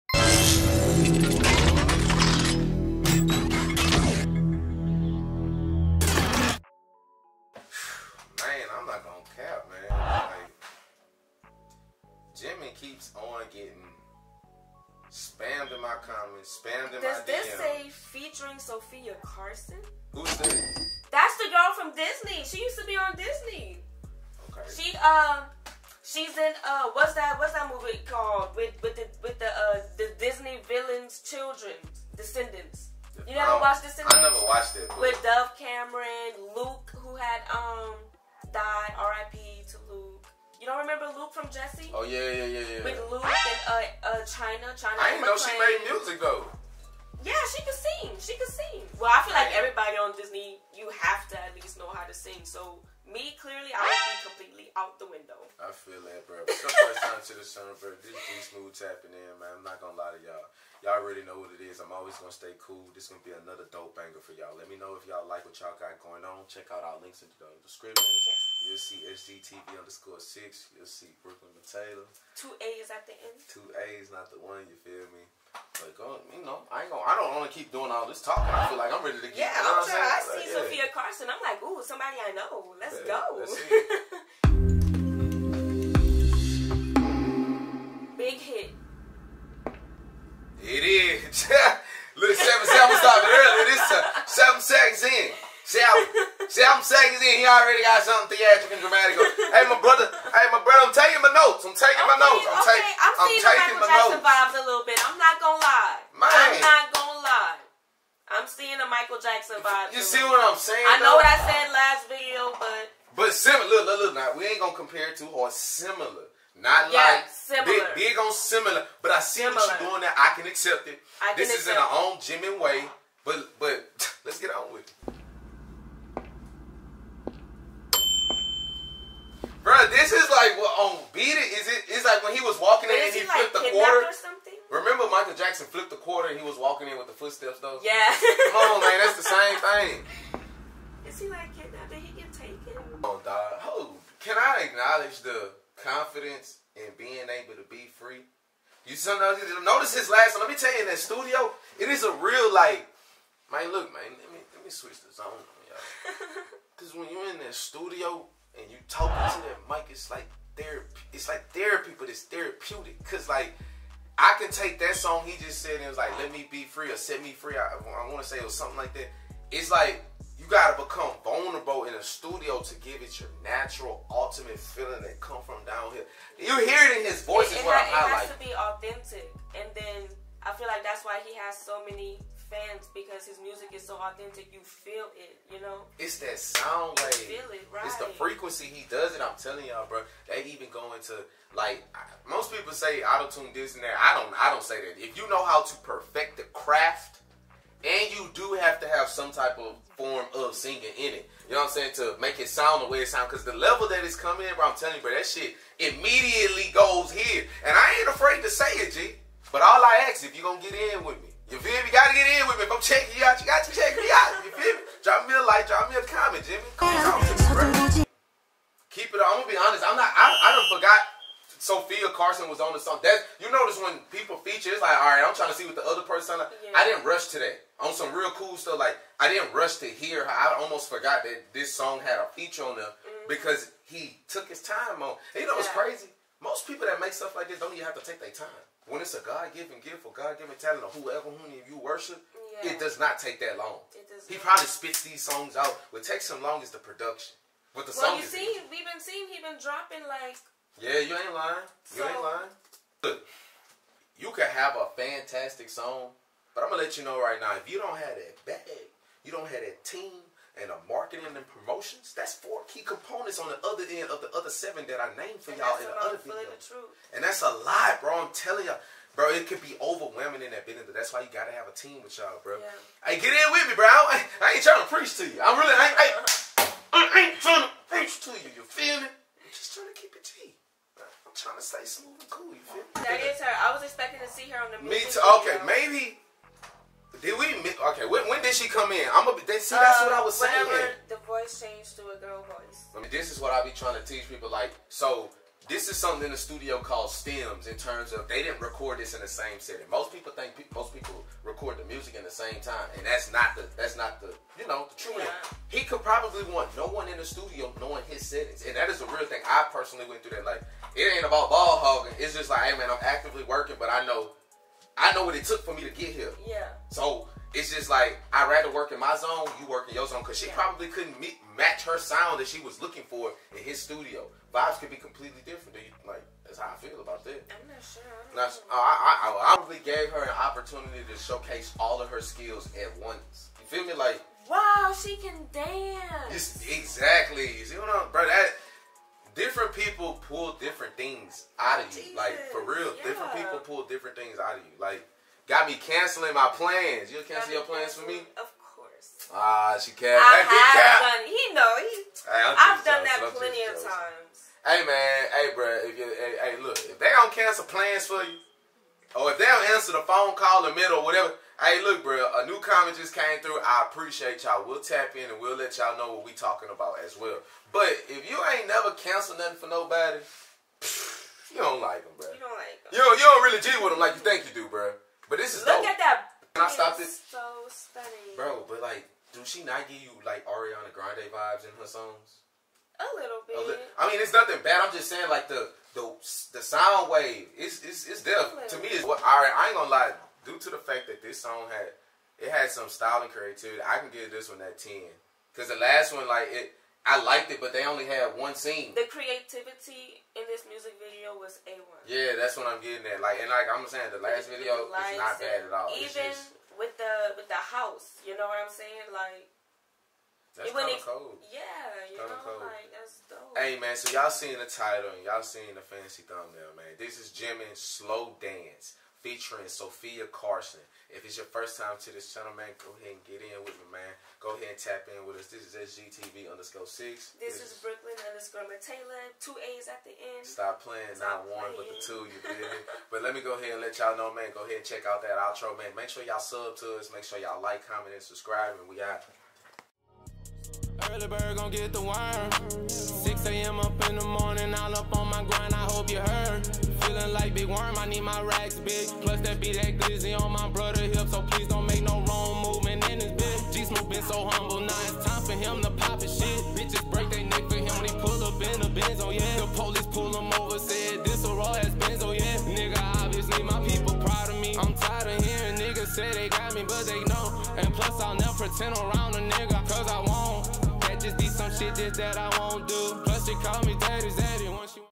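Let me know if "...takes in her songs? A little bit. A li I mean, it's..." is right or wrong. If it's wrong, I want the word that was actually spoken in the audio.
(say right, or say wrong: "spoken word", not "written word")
wrong: "vibes", not "takes".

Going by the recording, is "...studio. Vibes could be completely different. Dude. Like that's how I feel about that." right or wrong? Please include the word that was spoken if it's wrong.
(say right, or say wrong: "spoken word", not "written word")
right.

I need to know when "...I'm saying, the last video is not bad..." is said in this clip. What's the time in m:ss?
6:43.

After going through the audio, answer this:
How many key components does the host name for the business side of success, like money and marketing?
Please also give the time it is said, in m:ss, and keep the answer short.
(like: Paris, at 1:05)
4, at 4:22.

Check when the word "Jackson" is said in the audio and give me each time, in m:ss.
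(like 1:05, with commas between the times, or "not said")
1:43, 1:49, 2:15.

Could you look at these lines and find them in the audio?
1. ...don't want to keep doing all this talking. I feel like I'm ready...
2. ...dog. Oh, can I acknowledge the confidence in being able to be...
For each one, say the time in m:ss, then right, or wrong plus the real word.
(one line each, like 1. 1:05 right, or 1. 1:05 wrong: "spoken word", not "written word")
1. 1:17 right
2. 2:23 right.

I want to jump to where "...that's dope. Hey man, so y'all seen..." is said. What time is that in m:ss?
6:52.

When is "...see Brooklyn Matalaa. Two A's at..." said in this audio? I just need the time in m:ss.
1:10.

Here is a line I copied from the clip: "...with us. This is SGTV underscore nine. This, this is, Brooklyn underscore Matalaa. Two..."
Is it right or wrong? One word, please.
wrong.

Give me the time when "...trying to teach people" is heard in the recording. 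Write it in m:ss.
4:53.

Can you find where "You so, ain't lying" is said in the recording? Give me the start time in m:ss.
4:11.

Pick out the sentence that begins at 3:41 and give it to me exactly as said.
Sofia Carson was on the song.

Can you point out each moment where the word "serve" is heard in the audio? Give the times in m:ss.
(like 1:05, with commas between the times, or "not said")
not said.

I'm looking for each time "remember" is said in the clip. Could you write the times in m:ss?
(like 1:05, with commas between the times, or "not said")
0:40, 2:14.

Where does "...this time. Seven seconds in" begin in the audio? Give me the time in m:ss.
1:33.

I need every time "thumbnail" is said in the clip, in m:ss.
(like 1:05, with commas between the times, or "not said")
6:56.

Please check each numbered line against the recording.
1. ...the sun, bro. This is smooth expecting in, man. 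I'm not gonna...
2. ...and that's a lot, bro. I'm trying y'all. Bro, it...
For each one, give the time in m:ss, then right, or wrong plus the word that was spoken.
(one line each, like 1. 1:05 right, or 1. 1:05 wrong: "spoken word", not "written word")
1. 0:57 wrong: "tapping", not "expecting"
2. 4:27 wrong: "telling", not "trying".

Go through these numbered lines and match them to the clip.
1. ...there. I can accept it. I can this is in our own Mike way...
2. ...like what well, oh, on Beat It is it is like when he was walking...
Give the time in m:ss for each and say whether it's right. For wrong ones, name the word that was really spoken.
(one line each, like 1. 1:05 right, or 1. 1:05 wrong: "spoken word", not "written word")
1. 2:00 wrong: "Jimin", not "Mike"
2. 2:10 right.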